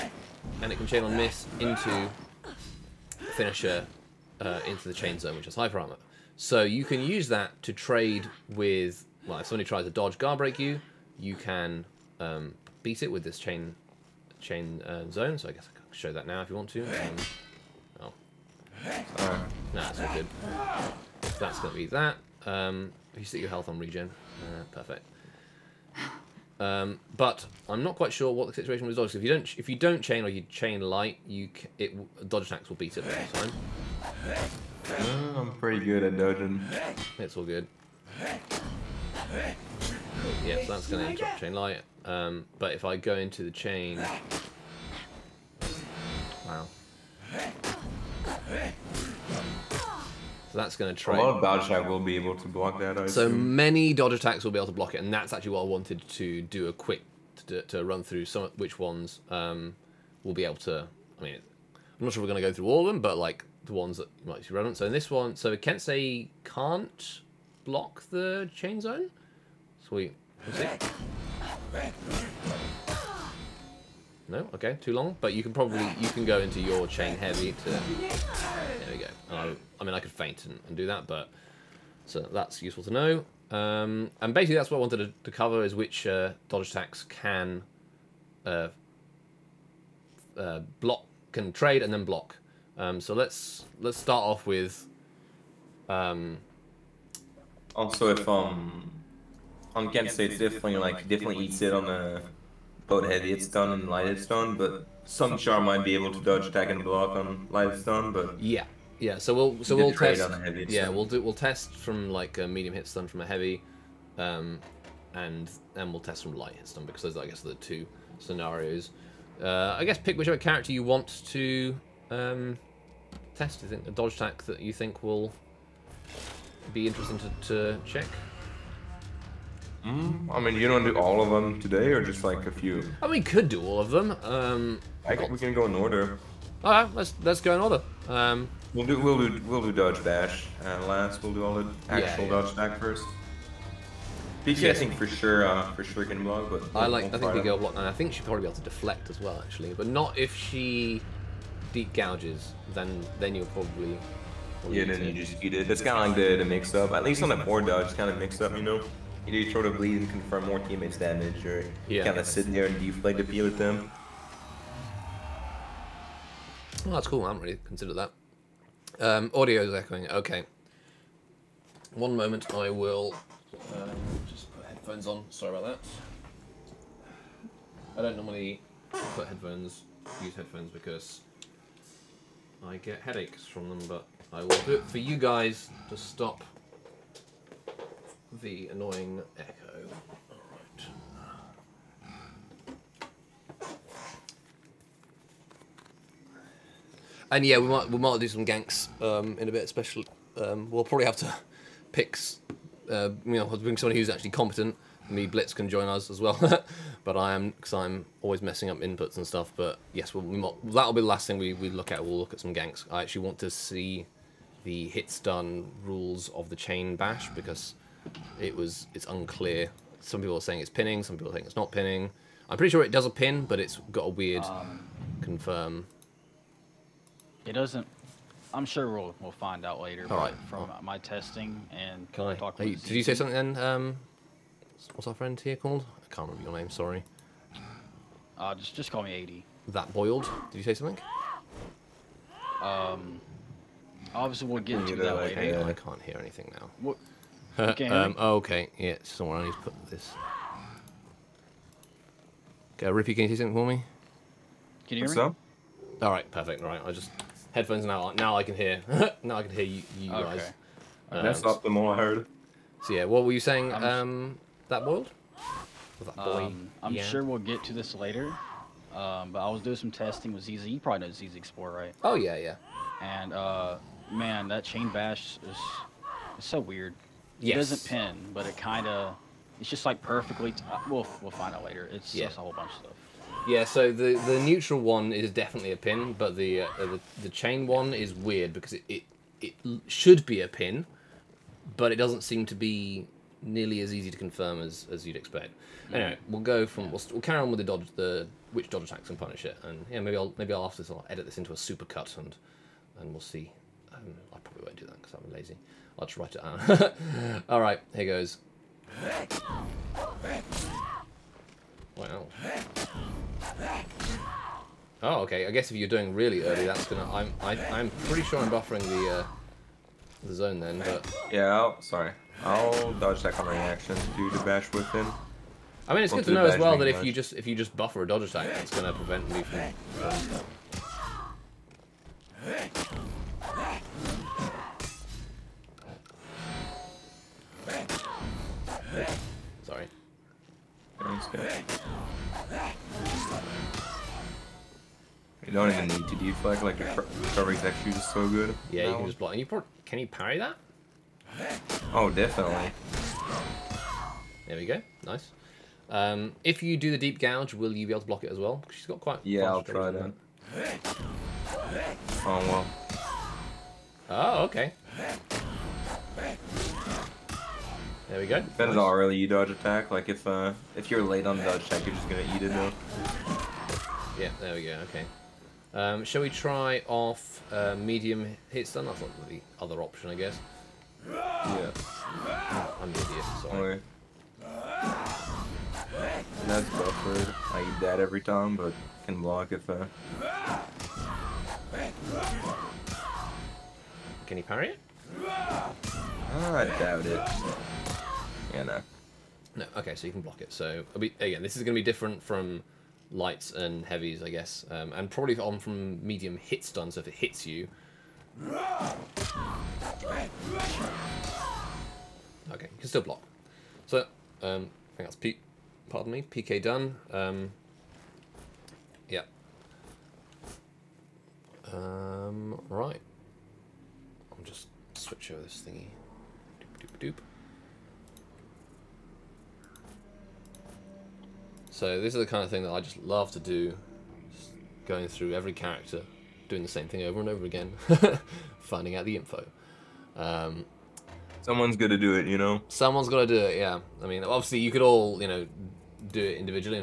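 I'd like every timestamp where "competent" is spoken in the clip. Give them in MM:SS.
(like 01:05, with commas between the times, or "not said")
03:24.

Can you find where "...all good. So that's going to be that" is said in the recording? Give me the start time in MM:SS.
00:19.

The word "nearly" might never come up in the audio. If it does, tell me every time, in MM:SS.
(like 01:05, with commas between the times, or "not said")
04:53.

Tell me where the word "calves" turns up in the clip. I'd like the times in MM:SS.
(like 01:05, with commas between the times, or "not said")
not said.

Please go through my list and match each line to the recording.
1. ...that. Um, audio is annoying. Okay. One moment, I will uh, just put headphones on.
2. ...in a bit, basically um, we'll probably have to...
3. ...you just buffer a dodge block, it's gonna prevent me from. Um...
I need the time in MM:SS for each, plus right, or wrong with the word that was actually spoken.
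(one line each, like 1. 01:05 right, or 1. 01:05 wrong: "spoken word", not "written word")
1. 02:47 wrong: "echoing", not "annoying"
2. 03:19 wrong: "especially", not "basically"
3. 05:27 wrong: "attack", not "block".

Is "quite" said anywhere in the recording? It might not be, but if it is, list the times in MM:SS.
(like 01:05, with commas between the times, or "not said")
00:27, 05:58.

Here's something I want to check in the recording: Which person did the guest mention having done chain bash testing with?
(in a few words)
ZZ Explorer.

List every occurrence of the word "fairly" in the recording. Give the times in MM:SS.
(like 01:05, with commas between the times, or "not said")
not said.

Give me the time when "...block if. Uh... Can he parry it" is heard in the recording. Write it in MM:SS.
06:29.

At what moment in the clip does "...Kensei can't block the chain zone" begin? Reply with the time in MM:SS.
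01:05.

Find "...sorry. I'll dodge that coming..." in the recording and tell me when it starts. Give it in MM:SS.
05:21.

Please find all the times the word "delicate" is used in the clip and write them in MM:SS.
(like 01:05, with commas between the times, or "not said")
not said.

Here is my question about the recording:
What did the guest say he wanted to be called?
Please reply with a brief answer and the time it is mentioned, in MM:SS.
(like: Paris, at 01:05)
80, at 03:59.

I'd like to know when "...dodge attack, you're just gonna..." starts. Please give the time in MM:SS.
06:11.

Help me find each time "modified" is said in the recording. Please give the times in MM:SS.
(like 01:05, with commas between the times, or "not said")
not said.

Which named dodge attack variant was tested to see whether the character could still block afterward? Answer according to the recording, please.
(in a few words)
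deep gouge.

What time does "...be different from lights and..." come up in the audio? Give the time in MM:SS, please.
06:41.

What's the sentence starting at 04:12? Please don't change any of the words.
Okay, Rippy, can you do something for me?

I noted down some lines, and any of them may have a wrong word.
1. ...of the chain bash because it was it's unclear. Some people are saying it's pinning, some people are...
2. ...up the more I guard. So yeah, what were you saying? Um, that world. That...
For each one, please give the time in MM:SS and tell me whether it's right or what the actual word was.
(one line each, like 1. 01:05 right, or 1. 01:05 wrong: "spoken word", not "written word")
1. 03:36 right
2. 04:21 wrong: "heard", not "guard".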